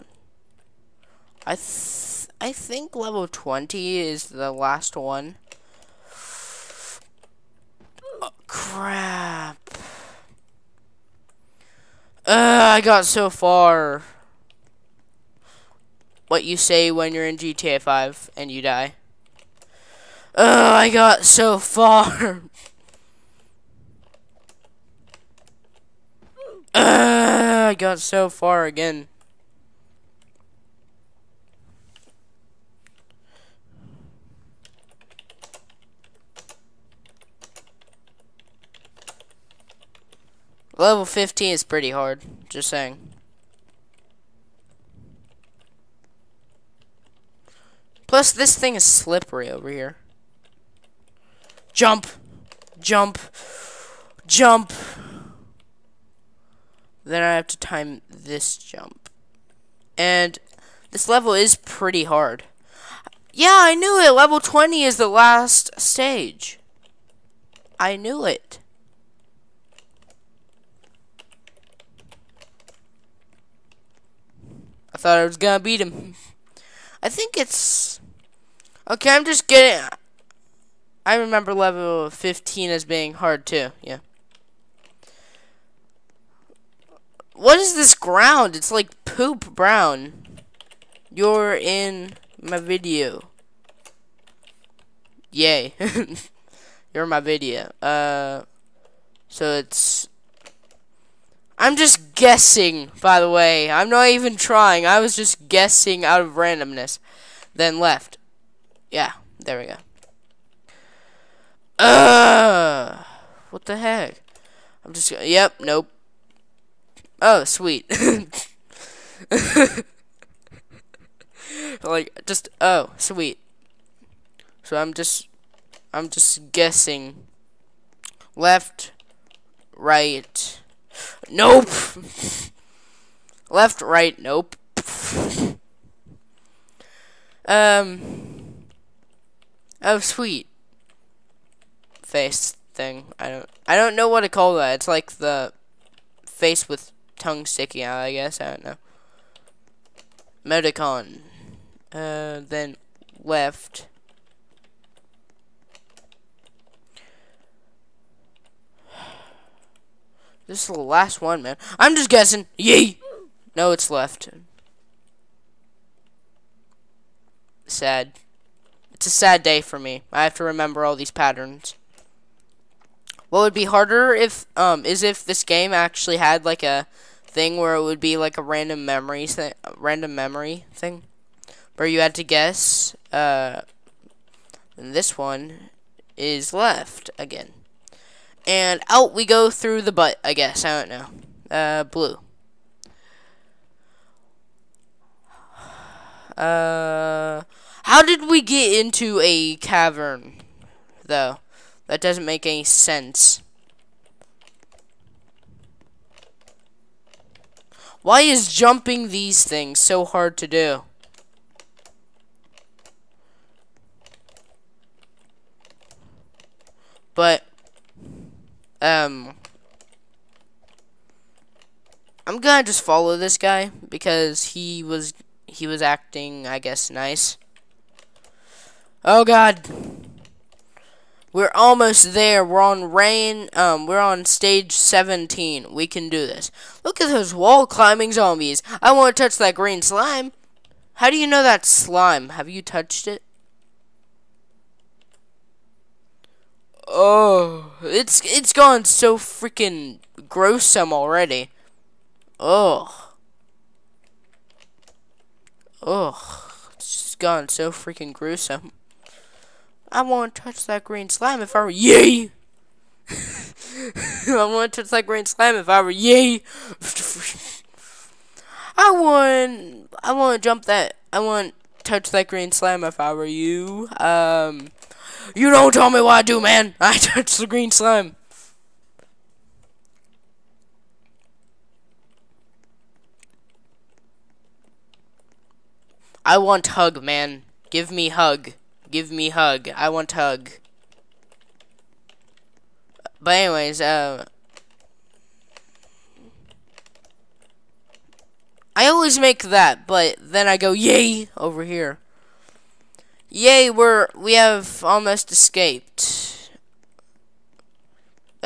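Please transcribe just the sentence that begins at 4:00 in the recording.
How do you know that's slime?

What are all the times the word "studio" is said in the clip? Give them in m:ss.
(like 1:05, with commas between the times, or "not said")
not said.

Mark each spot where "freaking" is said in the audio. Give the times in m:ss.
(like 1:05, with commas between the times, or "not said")
4:09, 4:17.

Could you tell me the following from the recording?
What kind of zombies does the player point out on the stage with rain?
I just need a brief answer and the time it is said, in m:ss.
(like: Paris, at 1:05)
Wall climbing zombies, at 3:57.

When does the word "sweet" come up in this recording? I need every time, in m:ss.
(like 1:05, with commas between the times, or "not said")
1:57, 2:02, 2:19.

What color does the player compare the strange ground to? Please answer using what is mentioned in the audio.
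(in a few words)
Poop brown.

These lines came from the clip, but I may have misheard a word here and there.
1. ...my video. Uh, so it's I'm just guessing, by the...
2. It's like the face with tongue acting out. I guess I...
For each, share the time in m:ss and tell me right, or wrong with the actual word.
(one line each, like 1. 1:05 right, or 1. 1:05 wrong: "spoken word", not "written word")
1. 1:37 right
2. 2:24 wrong: "sticking", not "acting".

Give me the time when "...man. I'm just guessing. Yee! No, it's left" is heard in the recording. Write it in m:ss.
2:41.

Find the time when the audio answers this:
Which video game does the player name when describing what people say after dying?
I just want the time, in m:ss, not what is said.
0:17.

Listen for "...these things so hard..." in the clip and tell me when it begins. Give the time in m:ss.
3:29.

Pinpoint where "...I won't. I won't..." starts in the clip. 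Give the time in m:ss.
4:28.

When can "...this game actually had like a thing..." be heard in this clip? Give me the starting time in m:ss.
2:55.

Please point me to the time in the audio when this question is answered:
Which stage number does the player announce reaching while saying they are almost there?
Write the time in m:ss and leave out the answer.
3:54.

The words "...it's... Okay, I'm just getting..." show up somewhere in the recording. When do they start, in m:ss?
1:17.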